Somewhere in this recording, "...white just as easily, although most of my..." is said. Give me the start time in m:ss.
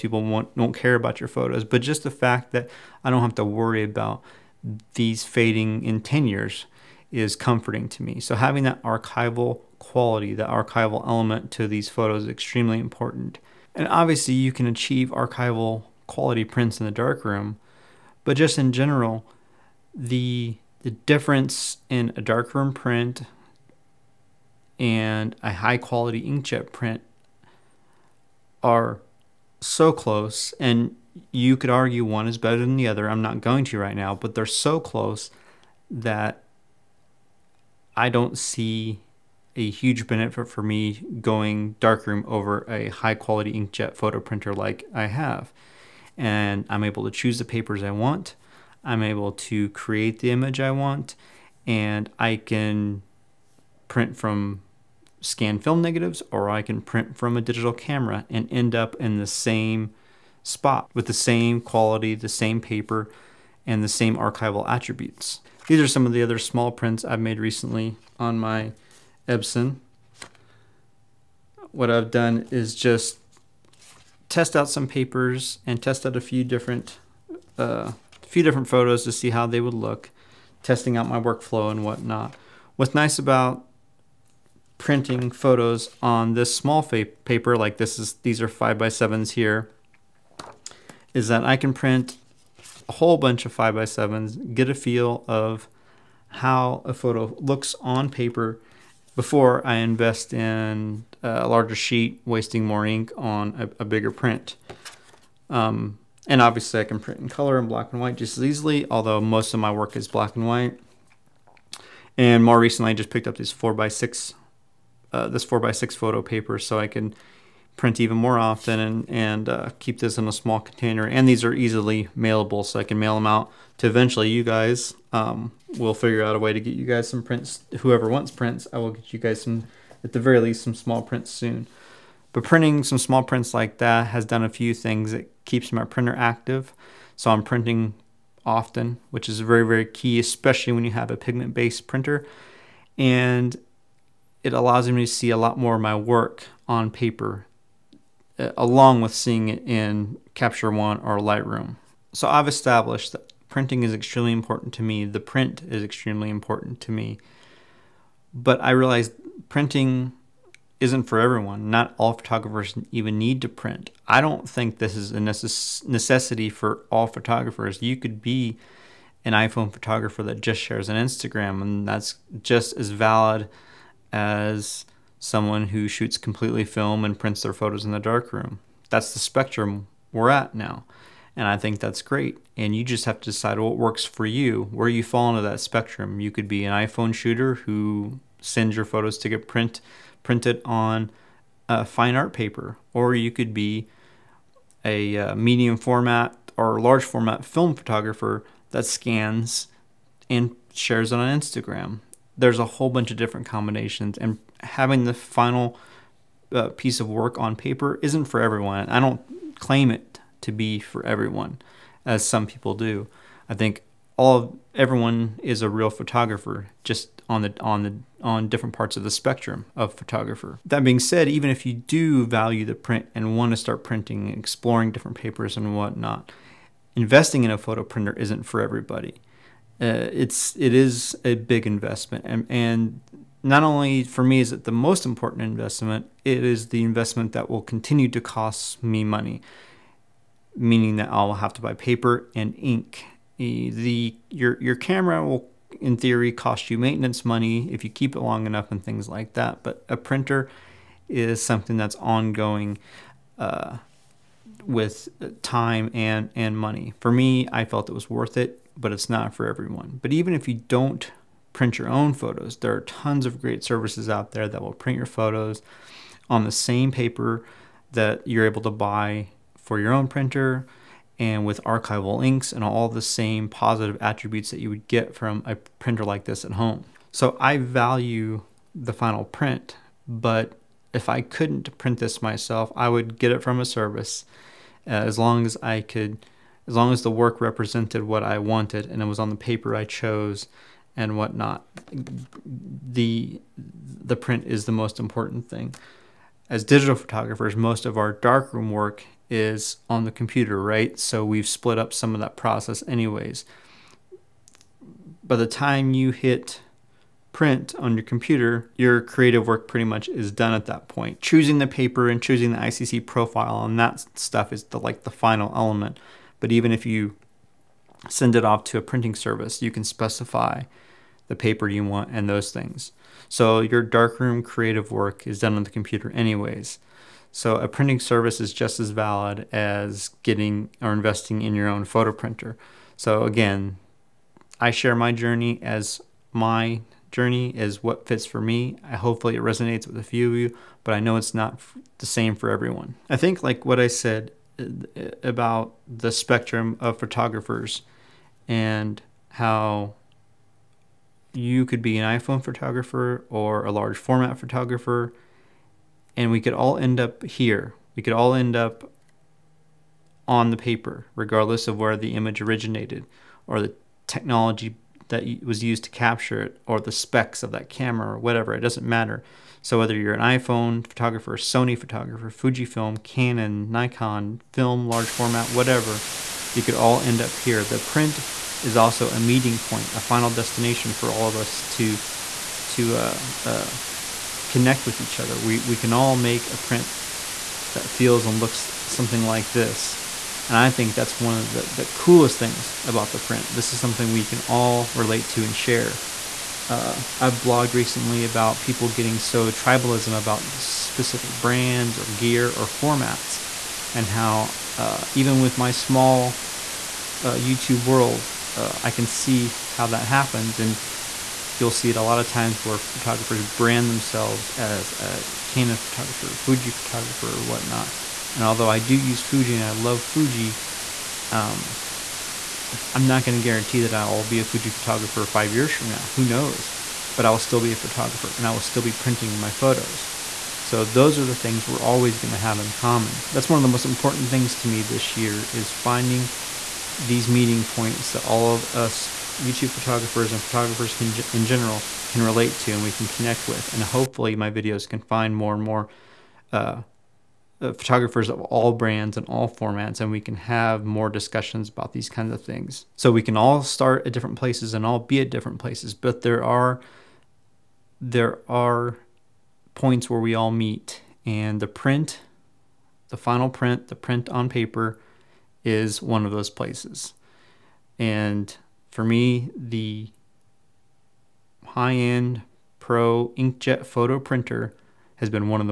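1:48.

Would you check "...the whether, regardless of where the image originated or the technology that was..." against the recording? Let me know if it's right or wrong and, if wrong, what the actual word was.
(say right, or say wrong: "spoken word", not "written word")
wrong: "paper", not "whether".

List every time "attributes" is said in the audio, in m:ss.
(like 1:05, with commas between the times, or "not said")
1:04, 4:34.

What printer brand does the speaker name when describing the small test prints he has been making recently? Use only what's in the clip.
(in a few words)
Epson.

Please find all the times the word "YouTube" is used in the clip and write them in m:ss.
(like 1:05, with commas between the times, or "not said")
6:47, 7:19.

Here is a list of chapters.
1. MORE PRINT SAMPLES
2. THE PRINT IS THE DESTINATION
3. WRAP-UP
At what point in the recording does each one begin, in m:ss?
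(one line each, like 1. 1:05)
1. 1:04
2. 5:42
3. 7:12.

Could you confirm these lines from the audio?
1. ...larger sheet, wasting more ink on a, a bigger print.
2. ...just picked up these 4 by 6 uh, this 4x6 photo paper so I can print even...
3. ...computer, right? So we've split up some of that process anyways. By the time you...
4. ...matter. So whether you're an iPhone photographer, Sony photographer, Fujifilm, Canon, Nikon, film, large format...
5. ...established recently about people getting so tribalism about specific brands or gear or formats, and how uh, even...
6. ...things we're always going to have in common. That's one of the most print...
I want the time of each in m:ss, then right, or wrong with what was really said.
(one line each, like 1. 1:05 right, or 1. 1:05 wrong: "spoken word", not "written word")
1. 1:41 right
2. 1:52 right
3. 5:00 right
4. 6:08 right
5. 6:37 wrong: "blogged", not "established"
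6. 7:11 wrong: "important", not "print".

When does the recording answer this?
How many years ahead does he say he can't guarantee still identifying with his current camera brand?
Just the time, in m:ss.
7:05.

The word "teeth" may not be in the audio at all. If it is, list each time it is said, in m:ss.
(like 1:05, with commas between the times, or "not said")
not said.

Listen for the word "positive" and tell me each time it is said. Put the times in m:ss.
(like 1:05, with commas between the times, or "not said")
4:33.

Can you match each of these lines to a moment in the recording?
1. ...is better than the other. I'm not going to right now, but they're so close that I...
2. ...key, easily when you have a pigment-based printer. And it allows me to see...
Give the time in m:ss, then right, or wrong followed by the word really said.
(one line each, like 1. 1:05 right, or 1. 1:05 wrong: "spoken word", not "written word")
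1. 0:32 right
2. 2:19 wrong: "especially", not "easily".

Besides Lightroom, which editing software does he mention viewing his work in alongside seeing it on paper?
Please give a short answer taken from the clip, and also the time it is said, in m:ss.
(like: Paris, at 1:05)
Capture One, at 2:30.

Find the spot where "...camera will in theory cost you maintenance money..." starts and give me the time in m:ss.
4:04.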